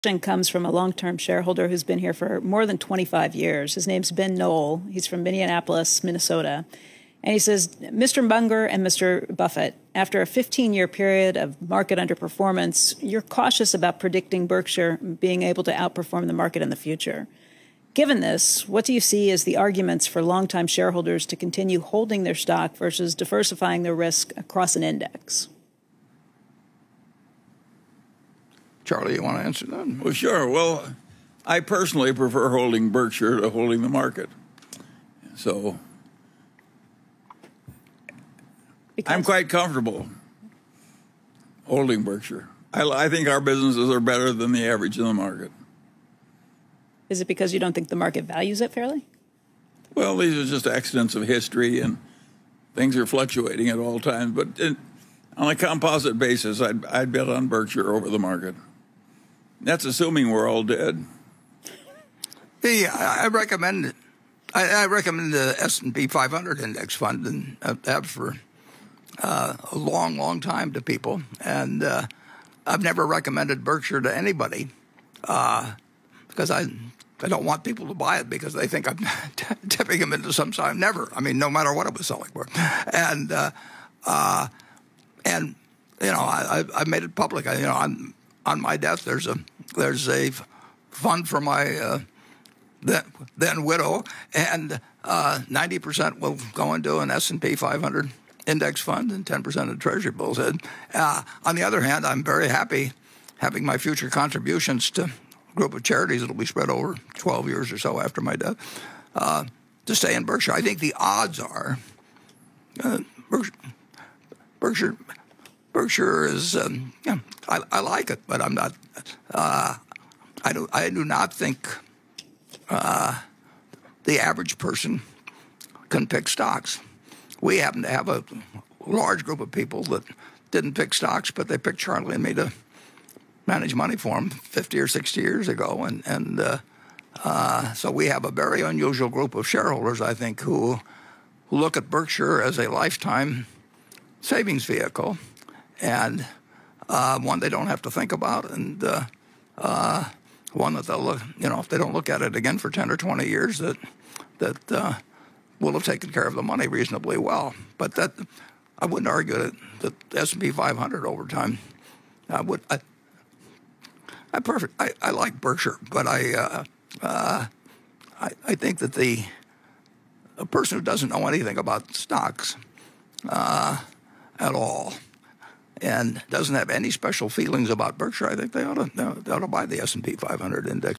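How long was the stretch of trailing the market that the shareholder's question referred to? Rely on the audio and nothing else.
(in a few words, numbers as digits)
15 year.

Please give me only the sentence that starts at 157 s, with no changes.
But that I wouldn't argue that the S&P 500 over time.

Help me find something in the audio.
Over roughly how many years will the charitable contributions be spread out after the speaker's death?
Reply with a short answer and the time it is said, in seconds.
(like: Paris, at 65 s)
12 years, at 107 s.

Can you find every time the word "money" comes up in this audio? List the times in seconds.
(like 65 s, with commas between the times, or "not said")
133 s, 156 s.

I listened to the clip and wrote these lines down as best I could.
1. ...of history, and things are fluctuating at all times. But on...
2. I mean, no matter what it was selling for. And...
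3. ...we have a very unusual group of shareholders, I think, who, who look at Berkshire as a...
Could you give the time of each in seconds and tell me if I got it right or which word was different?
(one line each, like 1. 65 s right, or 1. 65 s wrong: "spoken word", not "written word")
1. 51 s right
2. 81 s right
3. 137 s right.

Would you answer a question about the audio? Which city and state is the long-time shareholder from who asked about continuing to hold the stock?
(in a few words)
Minneapolis, Minnesota.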